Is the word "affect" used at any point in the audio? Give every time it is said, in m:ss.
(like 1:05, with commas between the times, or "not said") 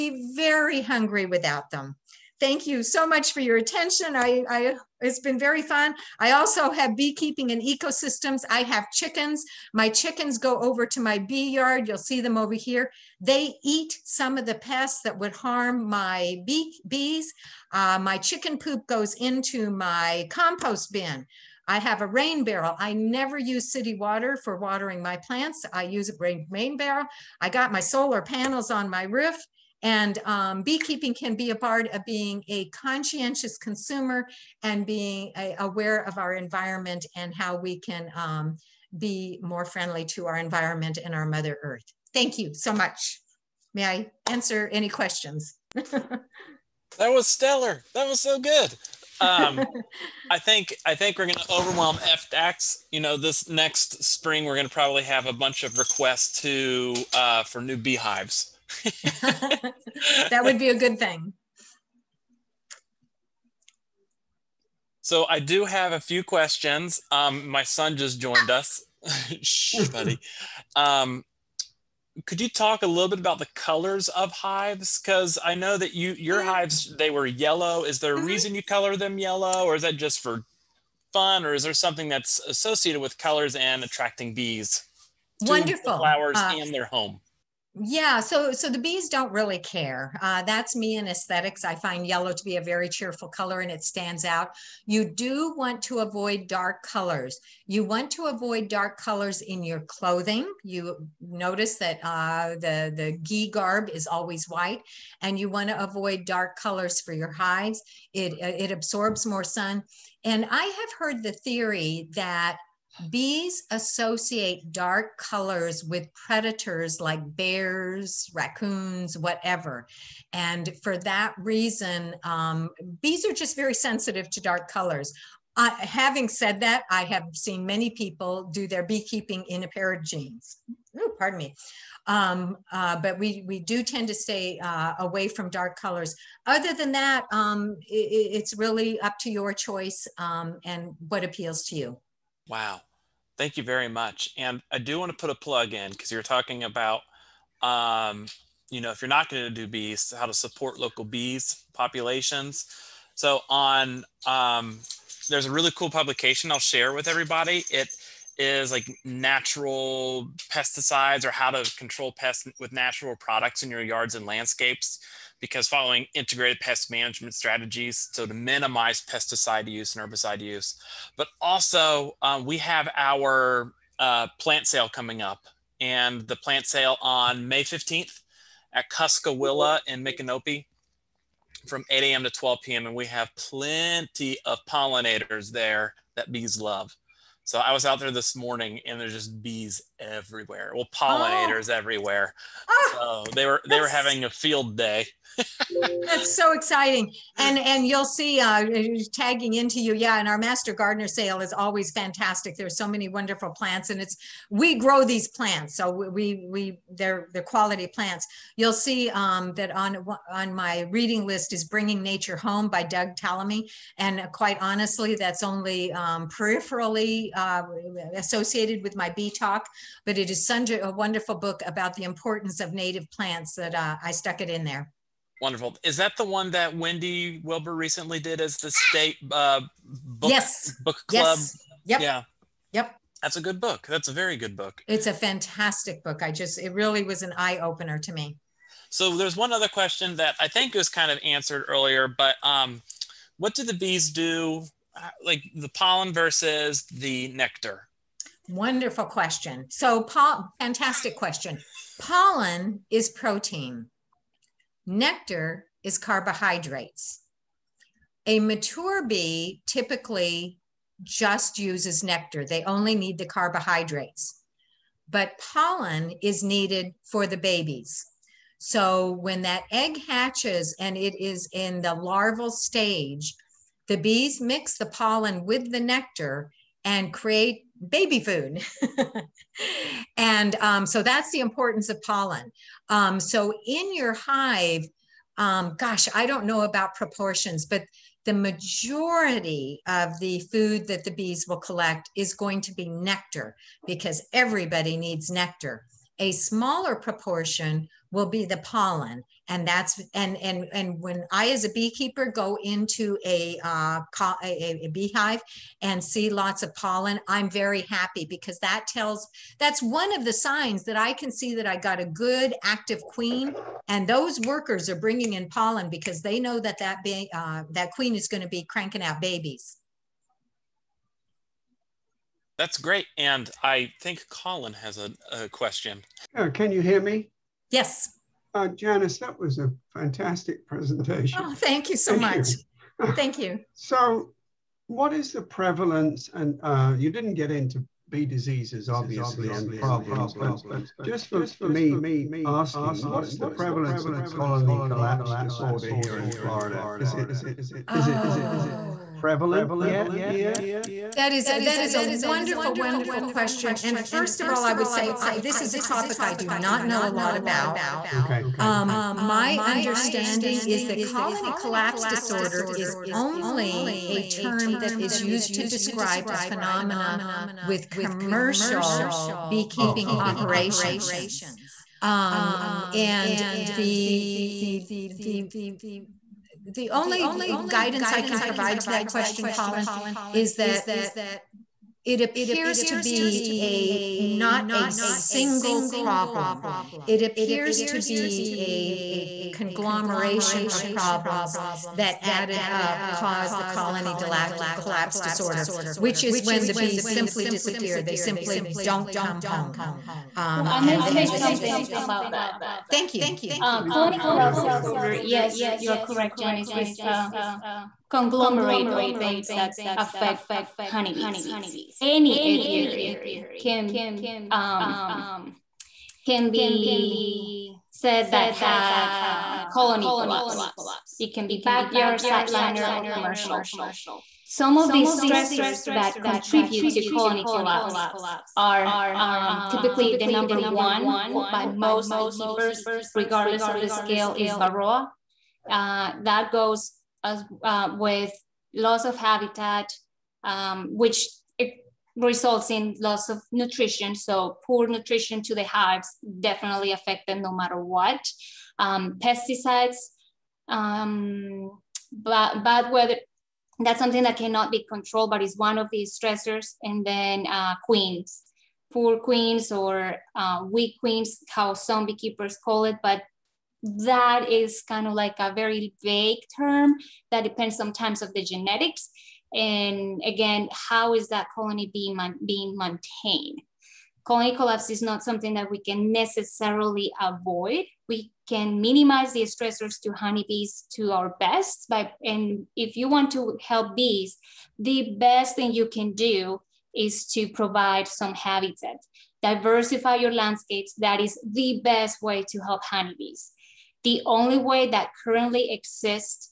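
6:49, 7:26.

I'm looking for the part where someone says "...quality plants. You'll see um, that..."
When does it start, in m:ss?
3:27.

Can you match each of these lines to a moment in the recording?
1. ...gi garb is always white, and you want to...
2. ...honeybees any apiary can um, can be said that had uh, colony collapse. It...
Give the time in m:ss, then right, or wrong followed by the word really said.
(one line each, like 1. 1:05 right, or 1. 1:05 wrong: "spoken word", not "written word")
1. 1:43 right
2. 6:50 right.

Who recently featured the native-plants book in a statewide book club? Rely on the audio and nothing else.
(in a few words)
Wendy Wilber.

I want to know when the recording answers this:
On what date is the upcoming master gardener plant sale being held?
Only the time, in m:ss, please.
2:57.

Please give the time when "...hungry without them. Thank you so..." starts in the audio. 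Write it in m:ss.
0:00.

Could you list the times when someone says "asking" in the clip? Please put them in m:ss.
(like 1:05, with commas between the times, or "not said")
5:42.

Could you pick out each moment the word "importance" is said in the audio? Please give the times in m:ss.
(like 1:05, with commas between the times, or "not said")
3:42, 4:41.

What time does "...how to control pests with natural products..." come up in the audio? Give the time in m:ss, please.
2:41.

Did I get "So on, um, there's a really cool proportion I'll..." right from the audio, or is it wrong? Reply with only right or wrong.
wrong.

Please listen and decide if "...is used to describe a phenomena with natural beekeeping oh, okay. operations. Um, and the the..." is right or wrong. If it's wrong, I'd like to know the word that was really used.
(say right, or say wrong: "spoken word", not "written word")
wrong: "commercial", not "natural".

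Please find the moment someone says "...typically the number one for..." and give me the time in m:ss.
7:09.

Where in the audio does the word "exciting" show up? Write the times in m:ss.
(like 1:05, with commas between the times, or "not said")
3:16.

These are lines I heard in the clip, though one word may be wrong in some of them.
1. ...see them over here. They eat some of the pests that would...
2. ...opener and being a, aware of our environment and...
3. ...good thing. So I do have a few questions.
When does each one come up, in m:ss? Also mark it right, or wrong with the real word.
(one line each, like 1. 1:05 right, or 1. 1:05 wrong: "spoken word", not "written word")
1. 0:11 right
2. 0:33 wrong: "consumer", not "opener"
3. 1:00 right.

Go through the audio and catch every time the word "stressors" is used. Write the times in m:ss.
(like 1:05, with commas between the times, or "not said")
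7:05, 7:36, 7:59.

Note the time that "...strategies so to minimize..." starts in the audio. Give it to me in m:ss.
2:47.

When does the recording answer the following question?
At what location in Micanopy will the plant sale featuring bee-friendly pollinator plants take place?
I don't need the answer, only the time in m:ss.
2:58.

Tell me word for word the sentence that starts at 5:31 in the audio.
Oh, thank you so thank much.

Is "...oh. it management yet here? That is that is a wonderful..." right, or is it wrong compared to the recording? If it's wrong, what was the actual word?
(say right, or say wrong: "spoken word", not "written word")
wrong: "prevalent", not "management".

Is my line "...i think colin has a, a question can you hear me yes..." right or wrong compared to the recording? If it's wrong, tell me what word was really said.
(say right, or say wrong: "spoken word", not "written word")
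right.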